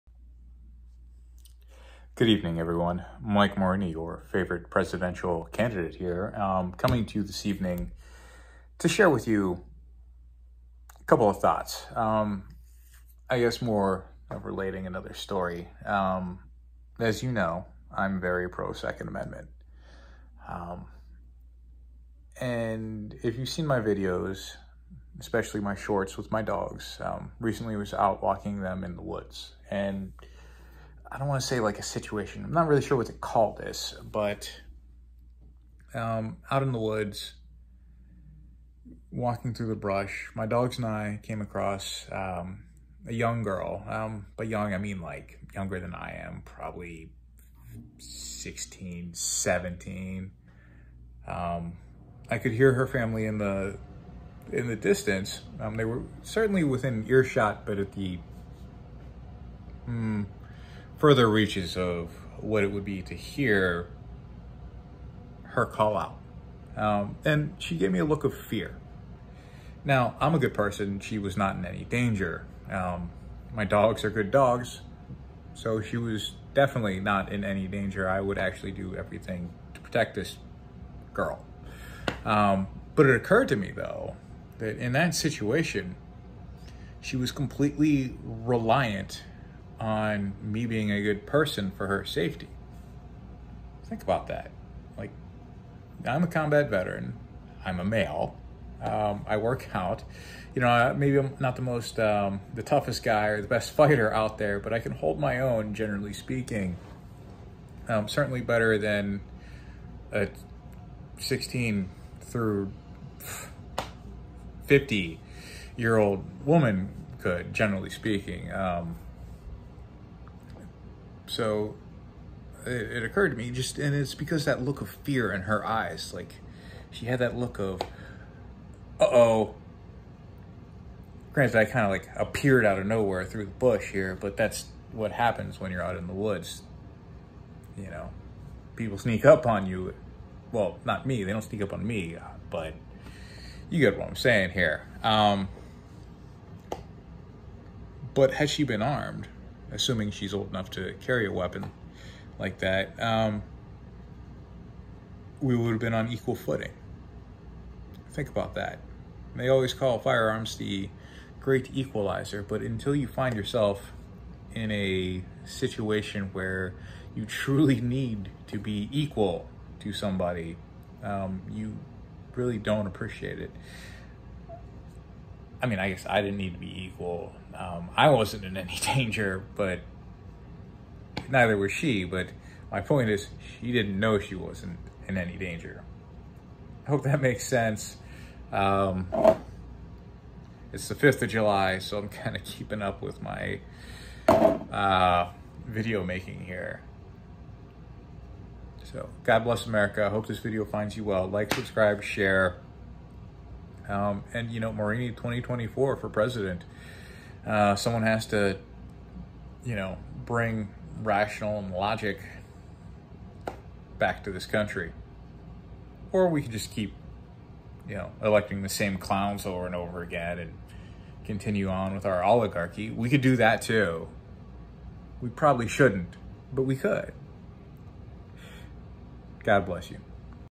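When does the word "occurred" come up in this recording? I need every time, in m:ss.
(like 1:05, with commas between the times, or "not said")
1:23, 2:03.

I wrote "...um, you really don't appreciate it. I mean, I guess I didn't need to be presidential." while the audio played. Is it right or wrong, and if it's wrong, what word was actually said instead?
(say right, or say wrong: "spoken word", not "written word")
wrong: "equal", not "presidential".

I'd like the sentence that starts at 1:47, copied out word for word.
Um, certainly better than a 16 through 50 year old woman could, generally speaking.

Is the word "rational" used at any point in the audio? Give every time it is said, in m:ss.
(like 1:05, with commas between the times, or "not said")
3:31.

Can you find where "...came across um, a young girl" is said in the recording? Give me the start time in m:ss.
0:41.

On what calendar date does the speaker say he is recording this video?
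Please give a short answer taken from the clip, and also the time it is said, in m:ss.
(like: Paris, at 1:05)
5th of July, at 3:10.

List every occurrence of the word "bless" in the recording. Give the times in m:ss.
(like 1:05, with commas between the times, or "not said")
3:19, 3:49.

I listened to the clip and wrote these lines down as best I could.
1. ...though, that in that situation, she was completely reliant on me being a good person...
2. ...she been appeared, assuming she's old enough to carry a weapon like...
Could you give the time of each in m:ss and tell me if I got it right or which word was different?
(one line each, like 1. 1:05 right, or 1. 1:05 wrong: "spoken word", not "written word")
1. 1:23 right
2. 2:28 wrong: "armed", not "appeared".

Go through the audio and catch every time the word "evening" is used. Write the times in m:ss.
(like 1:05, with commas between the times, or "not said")
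0:02, 0:07.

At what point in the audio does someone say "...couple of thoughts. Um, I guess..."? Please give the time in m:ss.
0:11.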